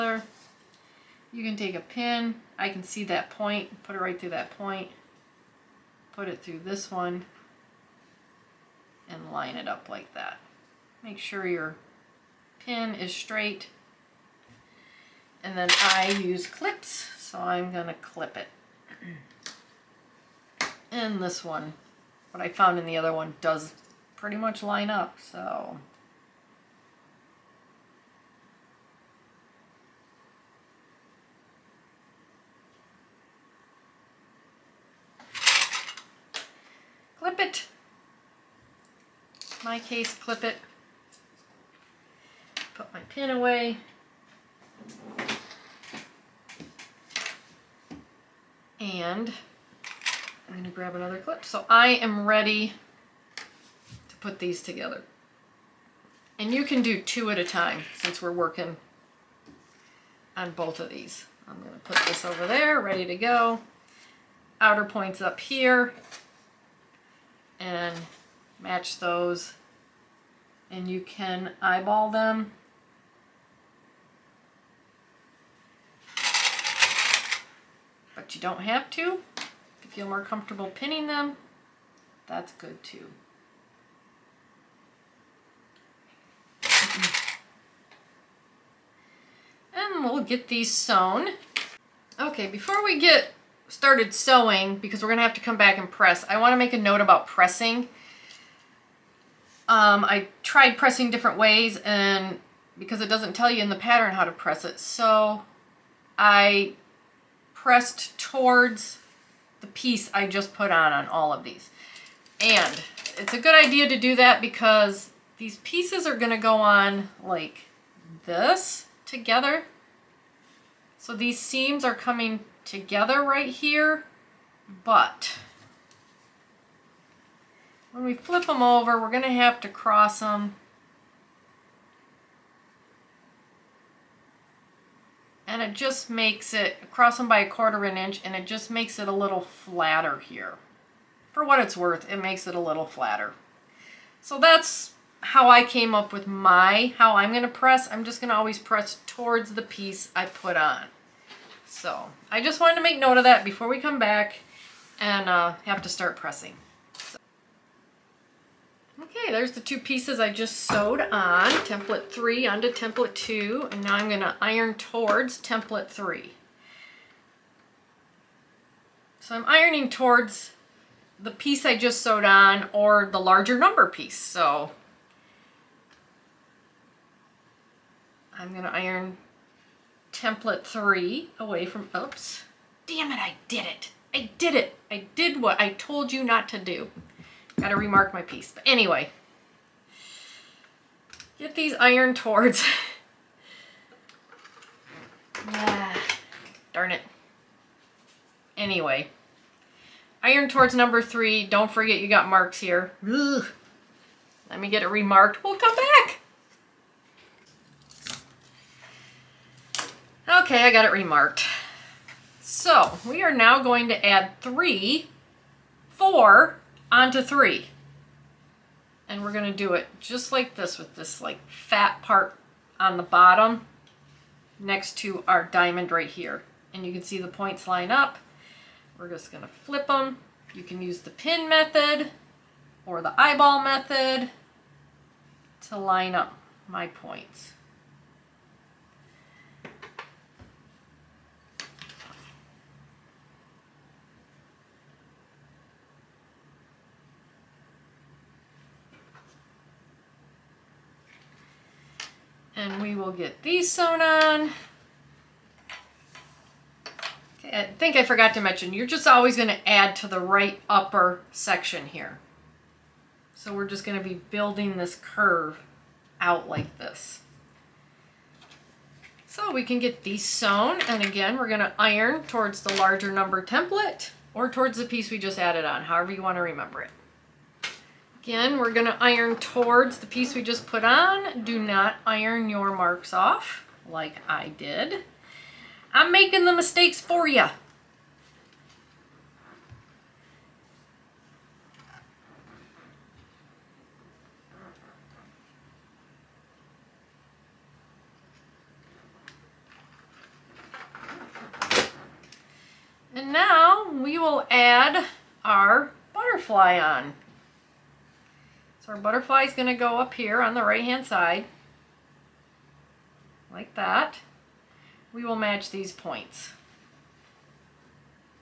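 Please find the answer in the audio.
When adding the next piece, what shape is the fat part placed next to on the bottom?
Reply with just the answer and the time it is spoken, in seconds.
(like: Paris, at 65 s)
diamond, at 225 s.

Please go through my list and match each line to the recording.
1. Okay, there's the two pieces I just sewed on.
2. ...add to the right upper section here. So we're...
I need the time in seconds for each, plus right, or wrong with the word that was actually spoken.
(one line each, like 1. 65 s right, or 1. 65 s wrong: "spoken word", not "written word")
1. 159 s right
2. 259 s right.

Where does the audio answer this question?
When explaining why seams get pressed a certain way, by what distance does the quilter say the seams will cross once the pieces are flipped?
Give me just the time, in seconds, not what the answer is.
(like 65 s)
137 s.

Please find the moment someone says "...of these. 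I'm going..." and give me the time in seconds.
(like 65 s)
60 s.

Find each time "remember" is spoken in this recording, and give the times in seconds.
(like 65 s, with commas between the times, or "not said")
276 s.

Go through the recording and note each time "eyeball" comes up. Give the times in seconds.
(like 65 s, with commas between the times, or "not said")
71 s, 233 s.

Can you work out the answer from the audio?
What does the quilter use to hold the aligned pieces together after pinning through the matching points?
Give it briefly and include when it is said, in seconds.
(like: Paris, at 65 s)
clips, at 16 s.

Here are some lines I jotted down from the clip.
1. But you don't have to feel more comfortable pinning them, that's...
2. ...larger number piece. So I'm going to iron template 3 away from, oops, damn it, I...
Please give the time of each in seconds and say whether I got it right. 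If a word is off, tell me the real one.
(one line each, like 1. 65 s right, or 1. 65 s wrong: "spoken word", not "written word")
1. 78 s right
2. 173 s right.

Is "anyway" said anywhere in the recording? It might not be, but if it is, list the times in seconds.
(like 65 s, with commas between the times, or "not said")
188 s, 198 s.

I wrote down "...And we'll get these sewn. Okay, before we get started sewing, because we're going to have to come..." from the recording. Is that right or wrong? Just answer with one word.
right.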